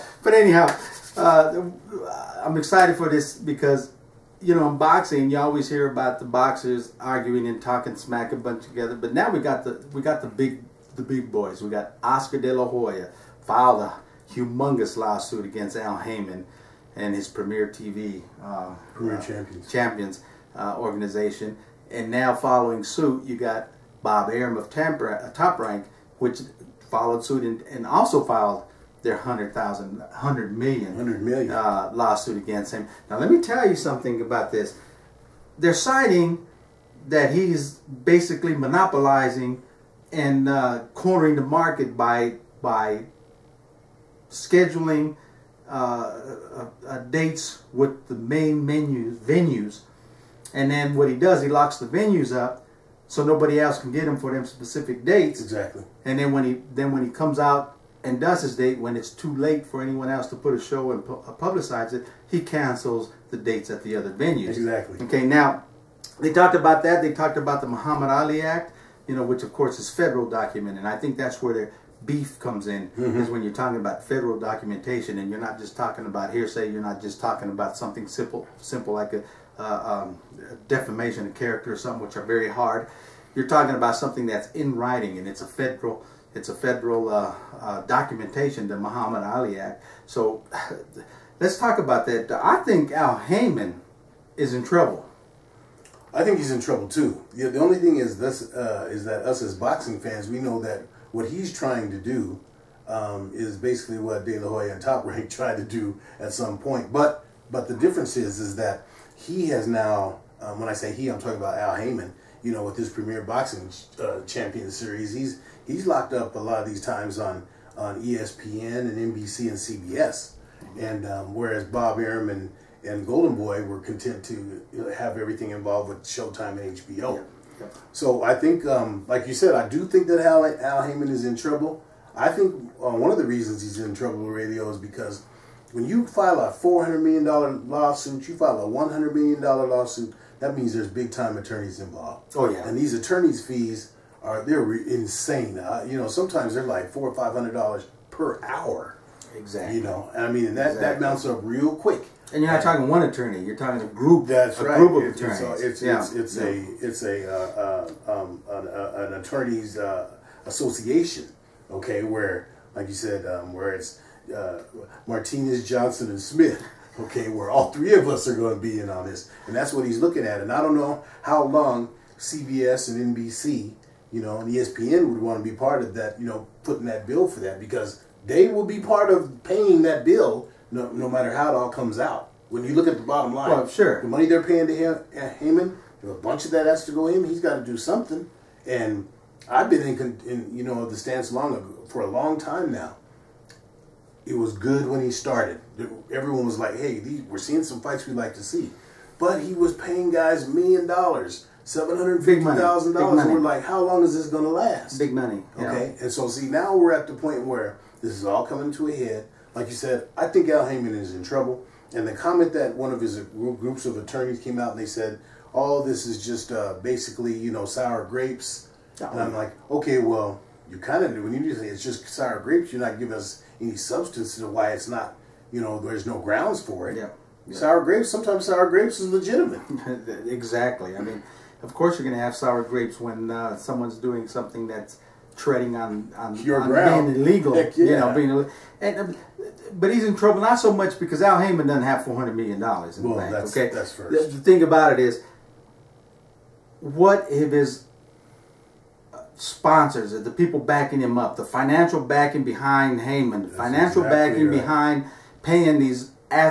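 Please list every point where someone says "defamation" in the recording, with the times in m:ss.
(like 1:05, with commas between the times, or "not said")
1:20.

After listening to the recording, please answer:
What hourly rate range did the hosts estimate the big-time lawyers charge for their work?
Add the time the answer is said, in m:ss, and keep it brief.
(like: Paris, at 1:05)
$400 to $500 per hour, at 2:26.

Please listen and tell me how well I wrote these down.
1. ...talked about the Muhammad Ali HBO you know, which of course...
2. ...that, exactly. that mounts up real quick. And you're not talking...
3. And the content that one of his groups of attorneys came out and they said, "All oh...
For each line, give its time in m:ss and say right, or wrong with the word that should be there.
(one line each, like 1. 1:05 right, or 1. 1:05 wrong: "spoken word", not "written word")
1. 1:07 wrong: "Act", not "HBO"
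2. 2:30 right
3. 3:31 wrong: "comment", not "content".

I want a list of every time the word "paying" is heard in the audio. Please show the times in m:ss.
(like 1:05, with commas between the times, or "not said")
2:59, 3:04, 3:19, 4:15.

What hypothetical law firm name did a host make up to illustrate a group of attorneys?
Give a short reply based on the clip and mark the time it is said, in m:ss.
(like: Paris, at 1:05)
Martinez, Johnson, and Smith, at 2:45.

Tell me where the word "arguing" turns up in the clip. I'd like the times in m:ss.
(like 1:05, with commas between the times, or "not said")
0:06.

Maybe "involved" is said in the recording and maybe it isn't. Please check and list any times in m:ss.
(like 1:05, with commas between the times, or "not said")
2:05, 2:21.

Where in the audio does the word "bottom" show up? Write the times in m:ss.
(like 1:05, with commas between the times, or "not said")
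3:03.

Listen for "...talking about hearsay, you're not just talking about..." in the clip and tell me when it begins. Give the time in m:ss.
1:15.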